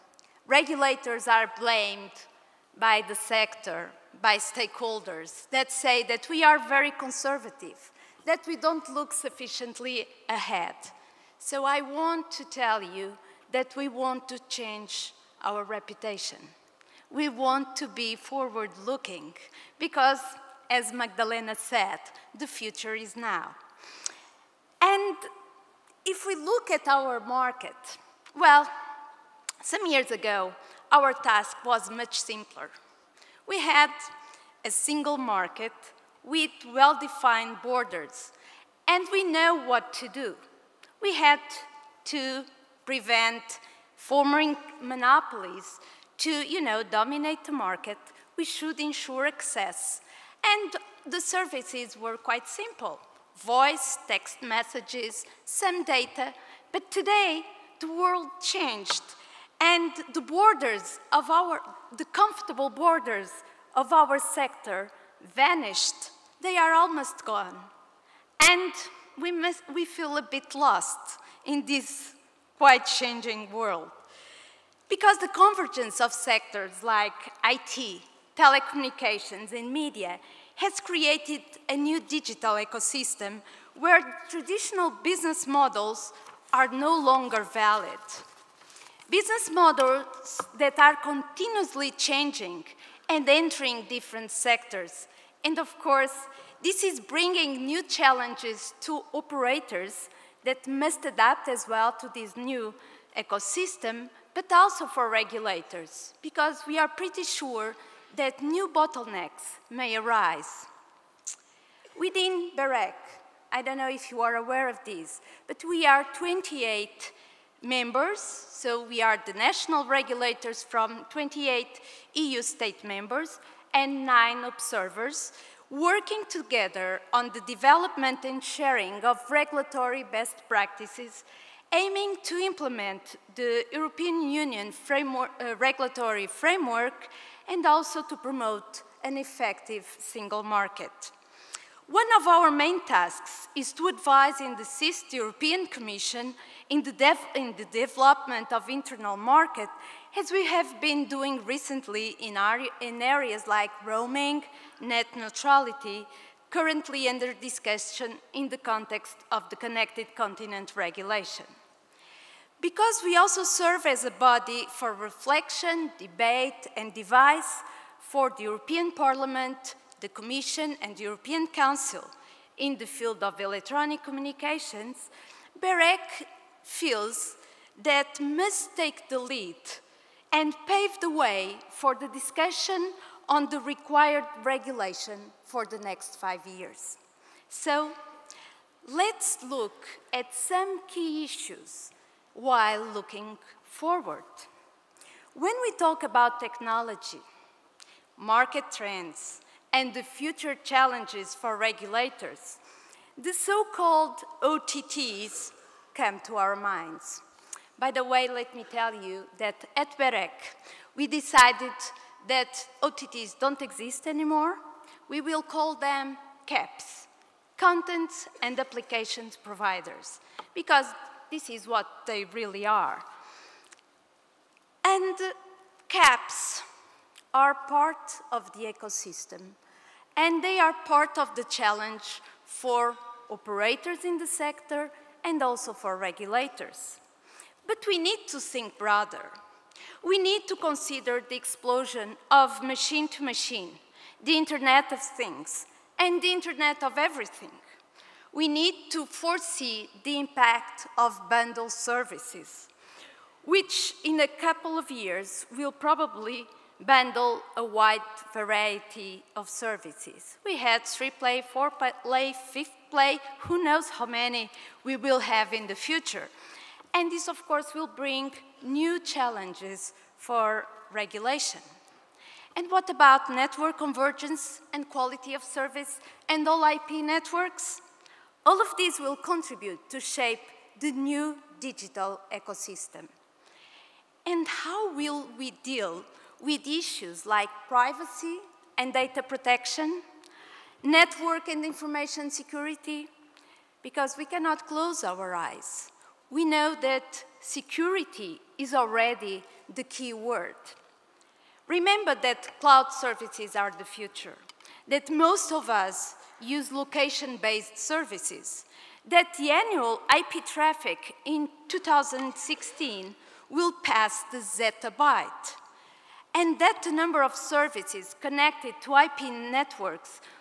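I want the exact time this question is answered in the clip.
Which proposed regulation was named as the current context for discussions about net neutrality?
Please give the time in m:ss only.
2:39.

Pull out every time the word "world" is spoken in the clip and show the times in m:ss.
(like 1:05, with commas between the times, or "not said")
0:57, 1:13.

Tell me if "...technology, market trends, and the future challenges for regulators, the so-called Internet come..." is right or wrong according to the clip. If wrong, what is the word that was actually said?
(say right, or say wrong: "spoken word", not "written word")
wrong: "OTTs", not "Internet".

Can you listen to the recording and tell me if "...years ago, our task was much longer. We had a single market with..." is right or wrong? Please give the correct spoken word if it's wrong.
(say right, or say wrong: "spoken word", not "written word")
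wrong: "simpler", not "longer".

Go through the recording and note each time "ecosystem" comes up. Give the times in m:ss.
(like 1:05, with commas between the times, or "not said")
1:22, 1:43, 3:48, 4:42.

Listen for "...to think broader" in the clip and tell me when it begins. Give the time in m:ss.
3:58.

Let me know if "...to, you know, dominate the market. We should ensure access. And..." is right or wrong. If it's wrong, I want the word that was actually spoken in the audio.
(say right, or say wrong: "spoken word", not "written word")
right.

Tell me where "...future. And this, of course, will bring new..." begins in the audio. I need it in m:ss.
4:25.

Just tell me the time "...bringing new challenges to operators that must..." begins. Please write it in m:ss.
1:36.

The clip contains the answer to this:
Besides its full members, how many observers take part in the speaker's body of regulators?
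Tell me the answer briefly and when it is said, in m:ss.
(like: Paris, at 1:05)
9, at 2:04.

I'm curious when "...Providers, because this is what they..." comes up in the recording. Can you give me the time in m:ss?
3:39.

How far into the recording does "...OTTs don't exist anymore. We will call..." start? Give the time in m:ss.
3:32.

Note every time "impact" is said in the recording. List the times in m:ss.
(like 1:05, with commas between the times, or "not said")
4:10.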